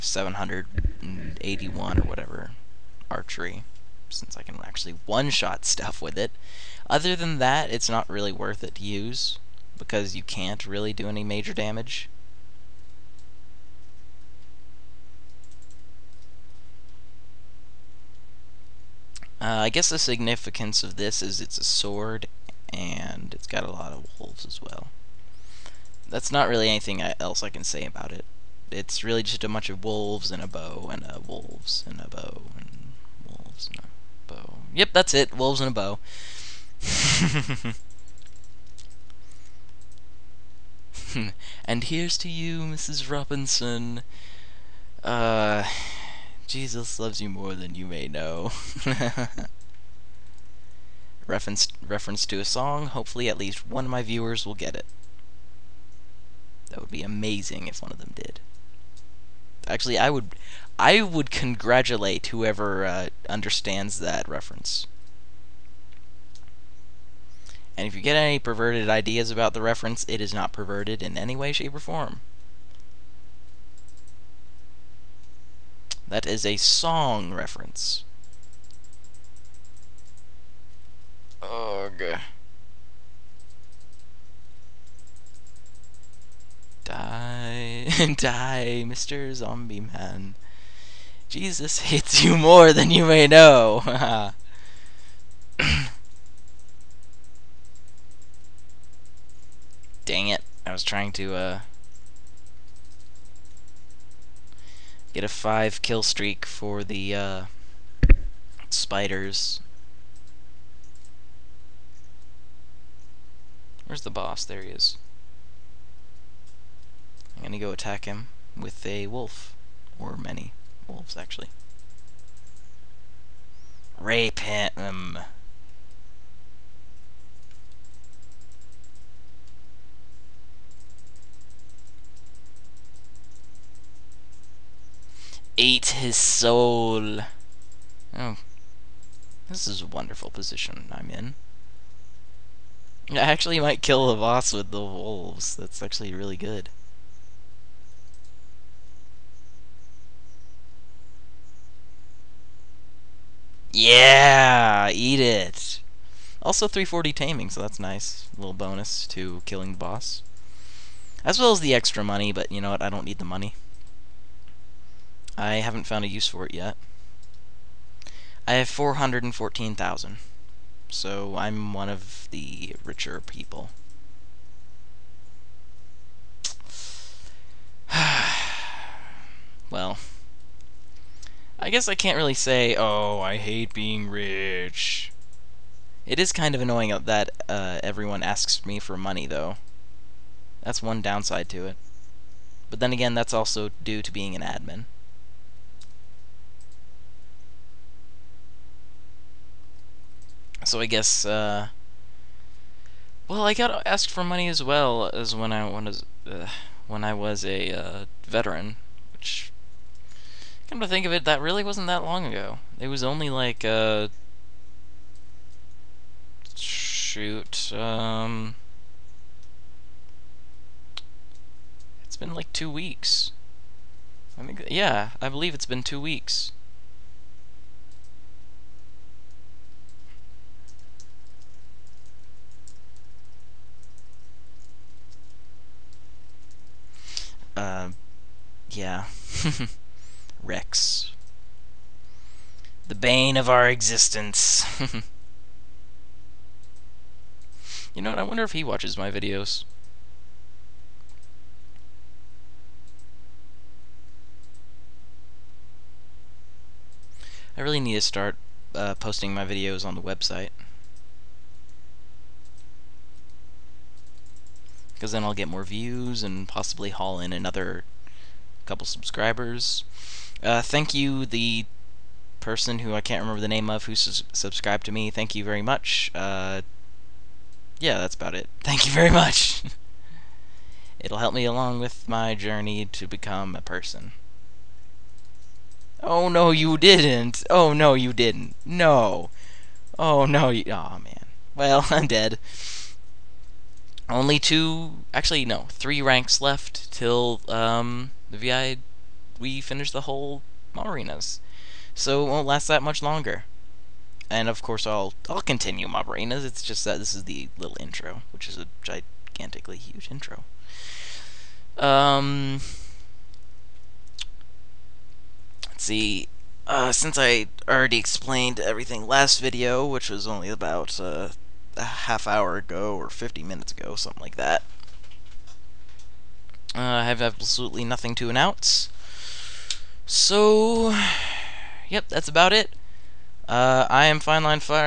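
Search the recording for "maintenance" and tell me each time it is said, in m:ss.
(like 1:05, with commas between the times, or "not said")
not said.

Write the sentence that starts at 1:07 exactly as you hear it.
And if you get any perverted ideas about the reference, it is not perverted in any way, shape, or form.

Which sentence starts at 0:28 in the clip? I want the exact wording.
It's really just a bunch of wolves and a bow and a wolves and a bow and wolves and a bow.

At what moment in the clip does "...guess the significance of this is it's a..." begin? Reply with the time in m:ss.
0:19.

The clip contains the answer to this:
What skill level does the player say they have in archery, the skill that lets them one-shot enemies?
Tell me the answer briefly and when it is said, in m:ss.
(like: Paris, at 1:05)
781, at 0:00.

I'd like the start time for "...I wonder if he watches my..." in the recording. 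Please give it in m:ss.
4:08.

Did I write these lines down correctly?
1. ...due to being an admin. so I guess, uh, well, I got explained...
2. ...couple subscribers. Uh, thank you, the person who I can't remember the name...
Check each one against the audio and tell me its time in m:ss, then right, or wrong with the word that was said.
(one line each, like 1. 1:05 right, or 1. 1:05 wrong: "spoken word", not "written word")
1. 3:13 wrong: "asked", not "explained"
2. 4:28 right.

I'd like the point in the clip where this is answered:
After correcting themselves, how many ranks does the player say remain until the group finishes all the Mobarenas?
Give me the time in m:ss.
4:55.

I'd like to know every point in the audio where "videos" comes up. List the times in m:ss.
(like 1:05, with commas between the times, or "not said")
4:09, 4:19, 5:19.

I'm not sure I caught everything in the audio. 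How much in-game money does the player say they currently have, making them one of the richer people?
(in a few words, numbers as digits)
414,000.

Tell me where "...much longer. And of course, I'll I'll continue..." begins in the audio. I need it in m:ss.
5:02.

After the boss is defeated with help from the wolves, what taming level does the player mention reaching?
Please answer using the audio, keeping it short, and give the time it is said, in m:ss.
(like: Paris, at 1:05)
340, at 2:36.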